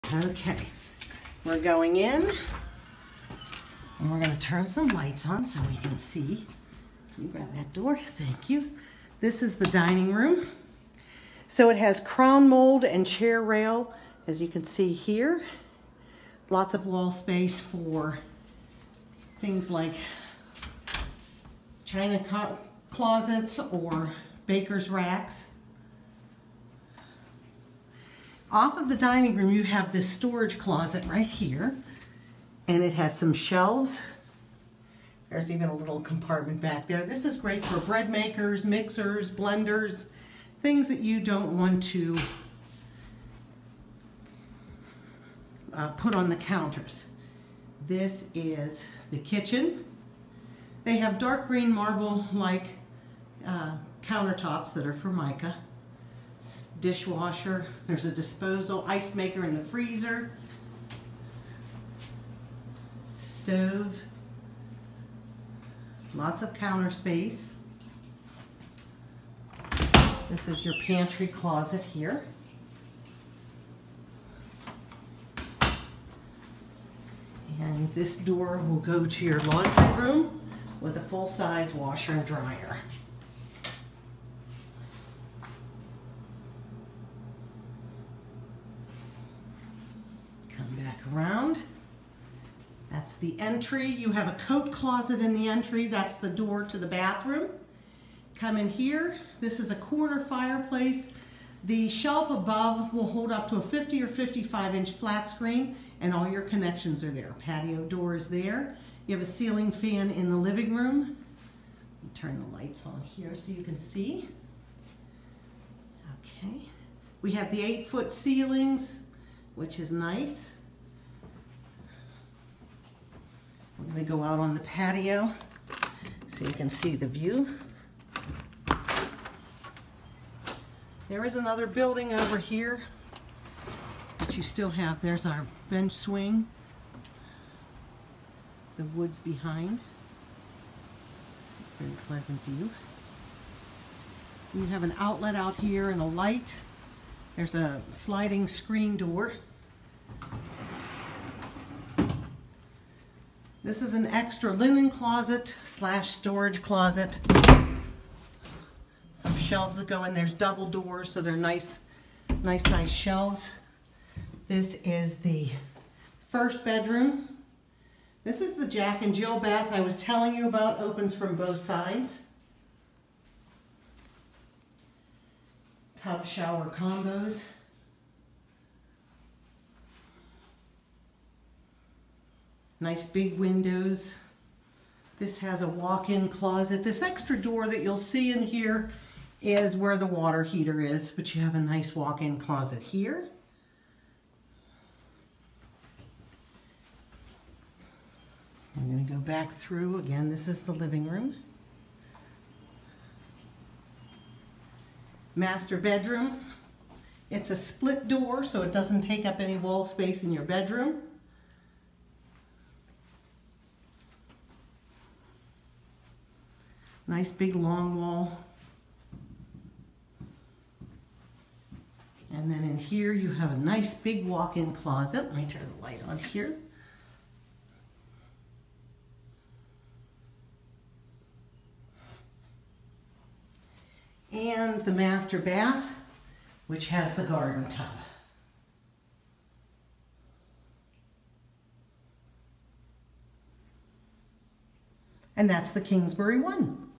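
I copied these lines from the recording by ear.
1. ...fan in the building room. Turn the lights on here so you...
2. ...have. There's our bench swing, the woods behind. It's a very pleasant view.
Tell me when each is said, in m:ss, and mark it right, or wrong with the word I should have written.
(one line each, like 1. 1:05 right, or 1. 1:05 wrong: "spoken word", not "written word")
1. 1:49 wrong: "living", not "building"
2. 2:14 right.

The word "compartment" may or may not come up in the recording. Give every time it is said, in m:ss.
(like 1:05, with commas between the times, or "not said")
0:36.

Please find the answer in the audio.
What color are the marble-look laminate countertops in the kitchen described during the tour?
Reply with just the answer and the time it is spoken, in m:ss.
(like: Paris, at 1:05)
Dark green, at 0:51.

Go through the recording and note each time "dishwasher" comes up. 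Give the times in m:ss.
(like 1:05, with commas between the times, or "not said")
0:56.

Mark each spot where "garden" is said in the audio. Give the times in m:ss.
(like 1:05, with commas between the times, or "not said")
3:57.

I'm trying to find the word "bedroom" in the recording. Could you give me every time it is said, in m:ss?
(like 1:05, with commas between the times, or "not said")
2:46, 3:25, 3:30.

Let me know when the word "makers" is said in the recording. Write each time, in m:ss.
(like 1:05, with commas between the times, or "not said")
0:38, 0:59.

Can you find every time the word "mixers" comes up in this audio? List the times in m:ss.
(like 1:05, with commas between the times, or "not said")
0:38.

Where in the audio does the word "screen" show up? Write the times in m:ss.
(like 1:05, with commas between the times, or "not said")
1:45, 2:28.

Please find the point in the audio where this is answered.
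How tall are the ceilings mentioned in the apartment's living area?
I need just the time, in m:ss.
1:57.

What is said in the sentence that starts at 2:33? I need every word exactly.
This is an extra linen closet slash storage closet.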